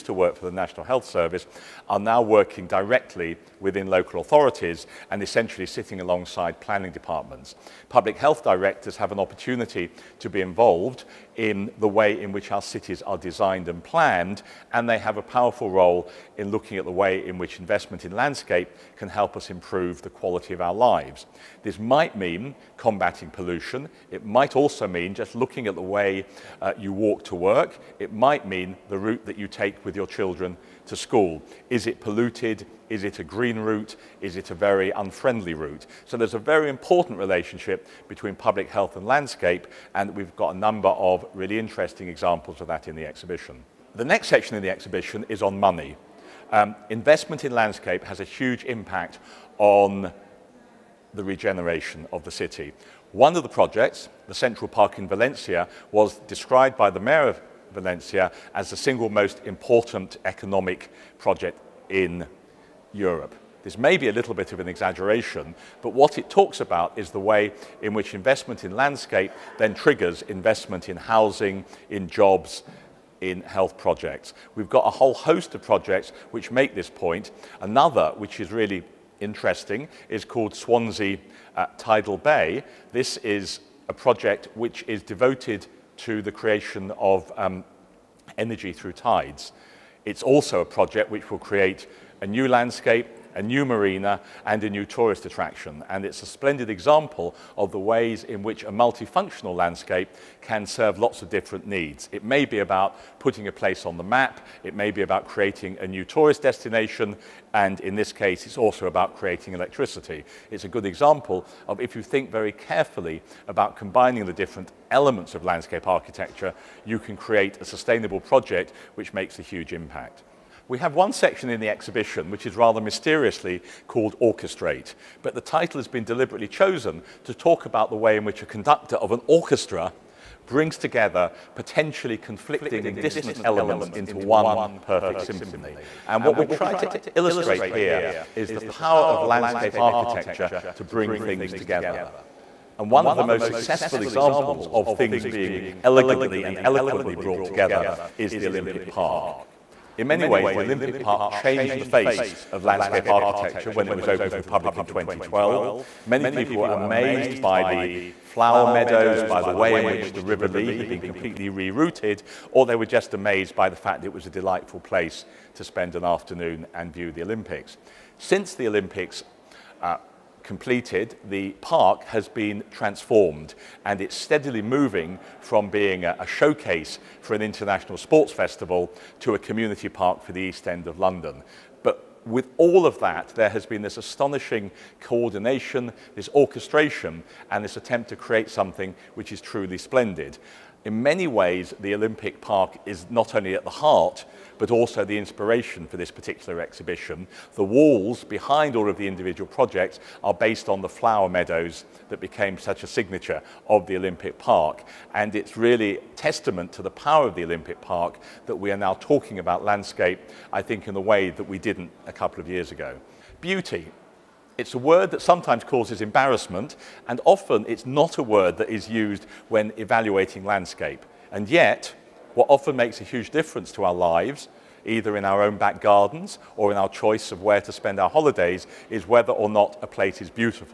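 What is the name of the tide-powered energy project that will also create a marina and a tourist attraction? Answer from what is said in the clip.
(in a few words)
Swansea Tidal Bay.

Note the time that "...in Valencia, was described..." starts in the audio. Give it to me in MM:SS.
00:54.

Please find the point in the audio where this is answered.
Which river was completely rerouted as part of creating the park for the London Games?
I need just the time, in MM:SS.
02:40.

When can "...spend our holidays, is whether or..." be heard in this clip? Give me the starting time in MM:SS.
03:47.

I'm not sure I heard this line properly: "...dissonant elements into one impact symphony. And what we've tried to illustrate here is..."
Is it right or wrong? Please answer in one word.
wrong.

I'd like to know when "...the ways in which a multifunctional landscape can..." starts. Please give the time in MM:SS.
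01:37.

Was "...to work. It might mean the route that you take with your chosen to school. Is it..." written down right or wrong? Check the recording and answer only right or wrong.
wrong.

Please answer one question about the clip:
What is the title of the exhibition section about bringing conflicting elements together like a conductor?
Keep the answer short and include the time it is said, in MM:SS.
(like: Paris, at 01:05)
Orchestrate, at 02:04.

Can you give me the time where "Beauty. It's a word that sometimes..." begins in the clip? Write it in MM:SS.
03:33.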